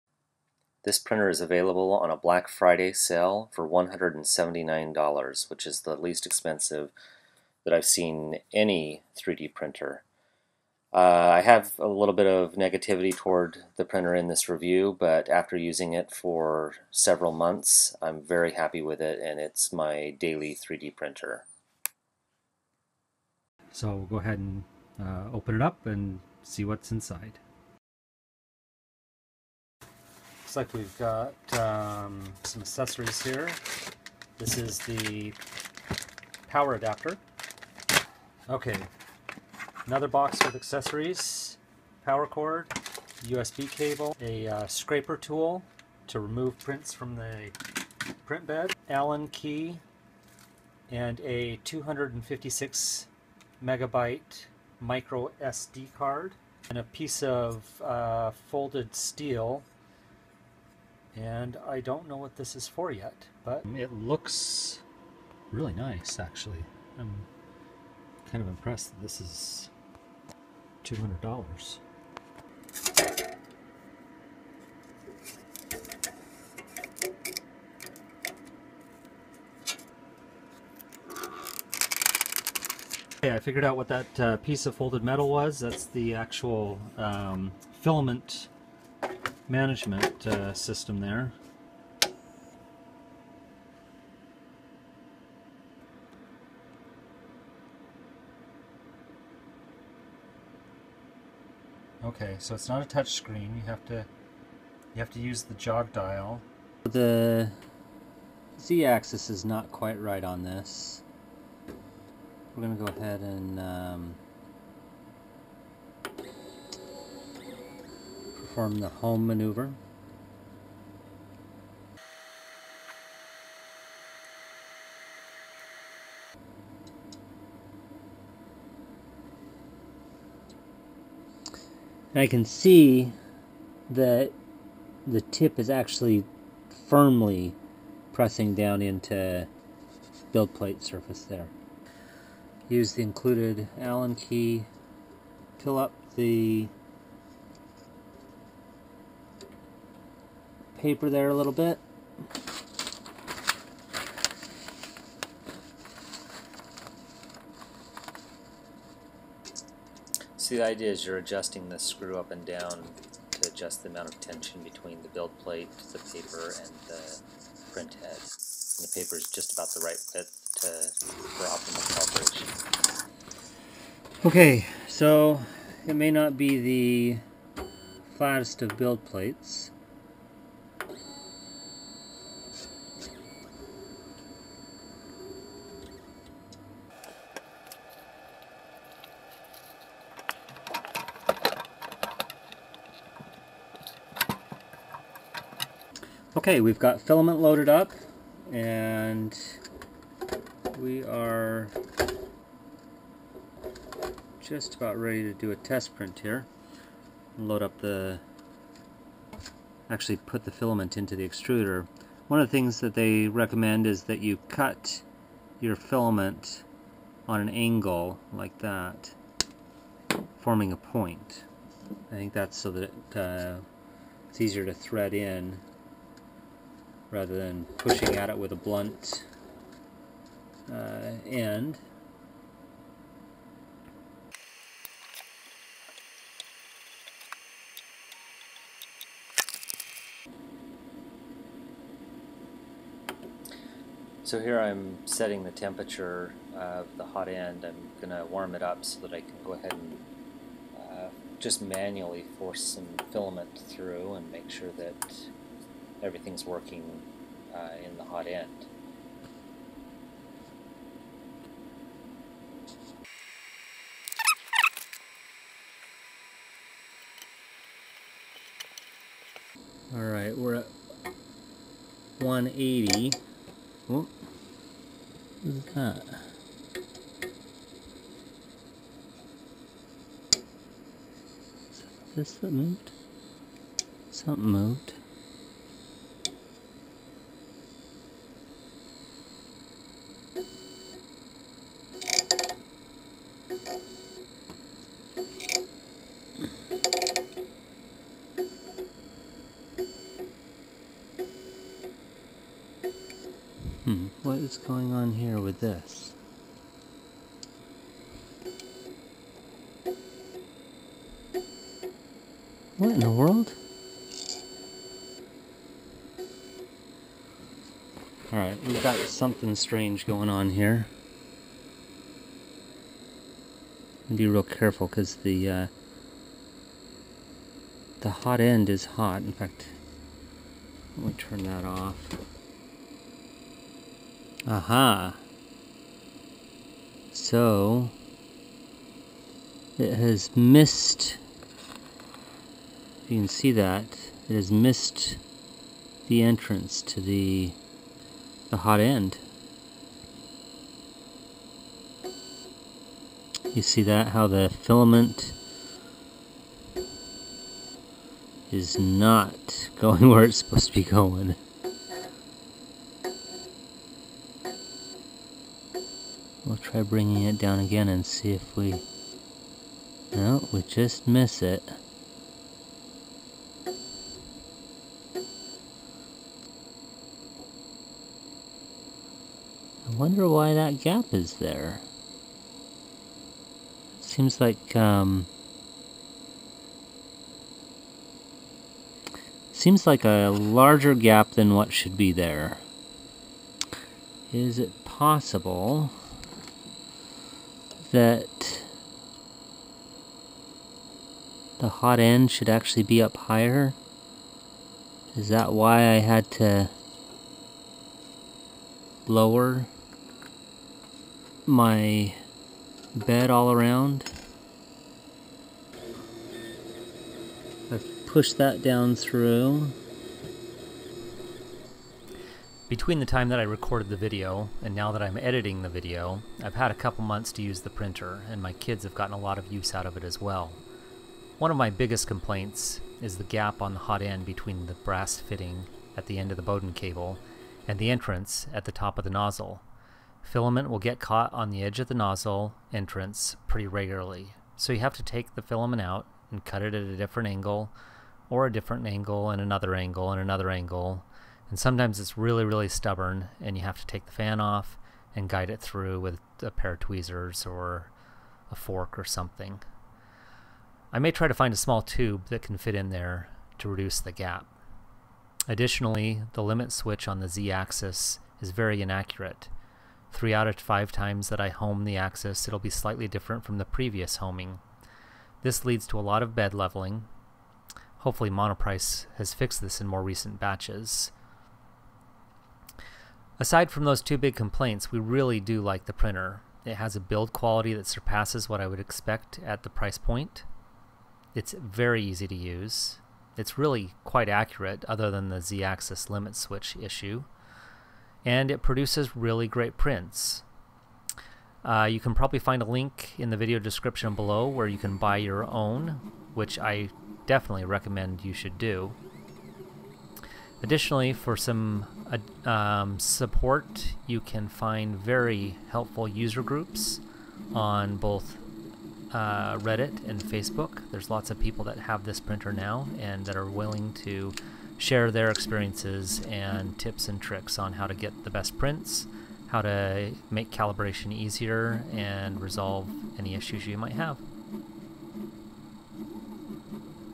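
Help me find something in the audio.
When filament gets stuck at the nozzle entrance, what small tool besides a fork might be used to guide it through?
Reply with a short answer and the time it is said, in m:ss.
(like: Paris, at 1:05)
tweezers, at 7:36.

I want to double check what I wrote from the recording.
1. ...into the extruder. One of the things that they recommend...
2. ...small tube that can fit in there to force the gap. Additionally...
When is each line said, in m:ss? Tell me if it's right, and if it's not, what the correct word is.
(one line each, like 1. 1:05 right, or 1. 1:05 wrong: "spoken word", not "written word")
1. 3:30 right
2. 7:41 wrong: "reduce", not "force".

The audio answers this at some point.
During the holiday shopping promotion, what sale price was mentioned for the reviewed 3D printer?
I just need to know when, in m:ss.
0:03.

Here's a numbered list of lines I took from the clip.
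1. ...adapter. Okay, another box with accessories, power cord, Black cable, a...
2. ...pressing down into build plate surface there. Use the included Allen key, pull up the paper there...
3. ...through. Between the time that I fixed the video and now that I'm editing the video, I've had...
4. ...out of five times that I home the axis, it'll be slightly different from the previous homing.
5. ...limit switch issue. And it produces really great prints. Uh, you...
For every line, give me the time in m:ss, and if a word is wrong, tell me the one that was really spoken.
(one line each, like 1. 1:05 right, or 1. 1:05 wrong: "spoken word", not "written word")
1. 0:36 wrong: "USB", not "Black"
2. 2:18 right
3. 6:58 wrong: "recorded", not "fixed"
4. 7:50 right
5. 8:16 right.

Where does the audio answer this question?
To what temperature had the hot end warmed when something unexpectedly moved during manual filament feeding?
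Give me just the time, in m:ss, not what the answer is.
4:32.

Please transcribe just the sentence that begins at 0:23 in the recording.
So we'll go ahead and uh, open it up and see what's inside.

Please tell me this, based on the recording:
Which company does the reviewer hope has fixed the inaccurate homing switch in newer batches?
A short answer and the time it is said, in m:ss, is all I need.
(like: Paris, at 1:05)
Monoprice, at 7:58.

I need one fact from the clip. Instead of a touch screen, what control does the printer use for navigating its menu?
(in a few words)
jog dial.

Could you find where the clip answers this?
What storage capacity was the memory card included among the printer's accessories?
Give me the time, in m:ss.
0:51.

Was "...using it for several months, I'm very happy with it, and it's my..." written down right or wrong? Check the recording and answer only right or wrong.
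right.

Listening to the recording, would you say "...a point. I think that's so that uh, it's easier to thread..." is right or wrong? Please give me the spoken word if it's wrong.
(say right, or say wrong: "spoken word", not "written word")
right.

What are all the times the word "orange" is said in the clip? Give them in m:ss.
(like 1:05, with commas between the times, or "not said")
not said.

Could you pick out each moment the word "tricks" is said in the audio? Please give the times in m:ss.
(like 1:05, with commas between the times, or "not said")
8:47.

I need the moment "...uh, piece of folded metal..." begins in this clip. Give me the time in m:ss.
1:24.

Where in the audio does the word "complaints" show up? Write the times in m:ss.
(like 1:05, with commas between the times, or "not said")
7:12, 8:04.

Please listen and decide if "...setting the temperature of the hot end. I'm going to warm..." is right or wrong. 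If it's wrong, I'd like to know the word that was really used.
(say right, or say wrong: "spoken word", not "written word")
right.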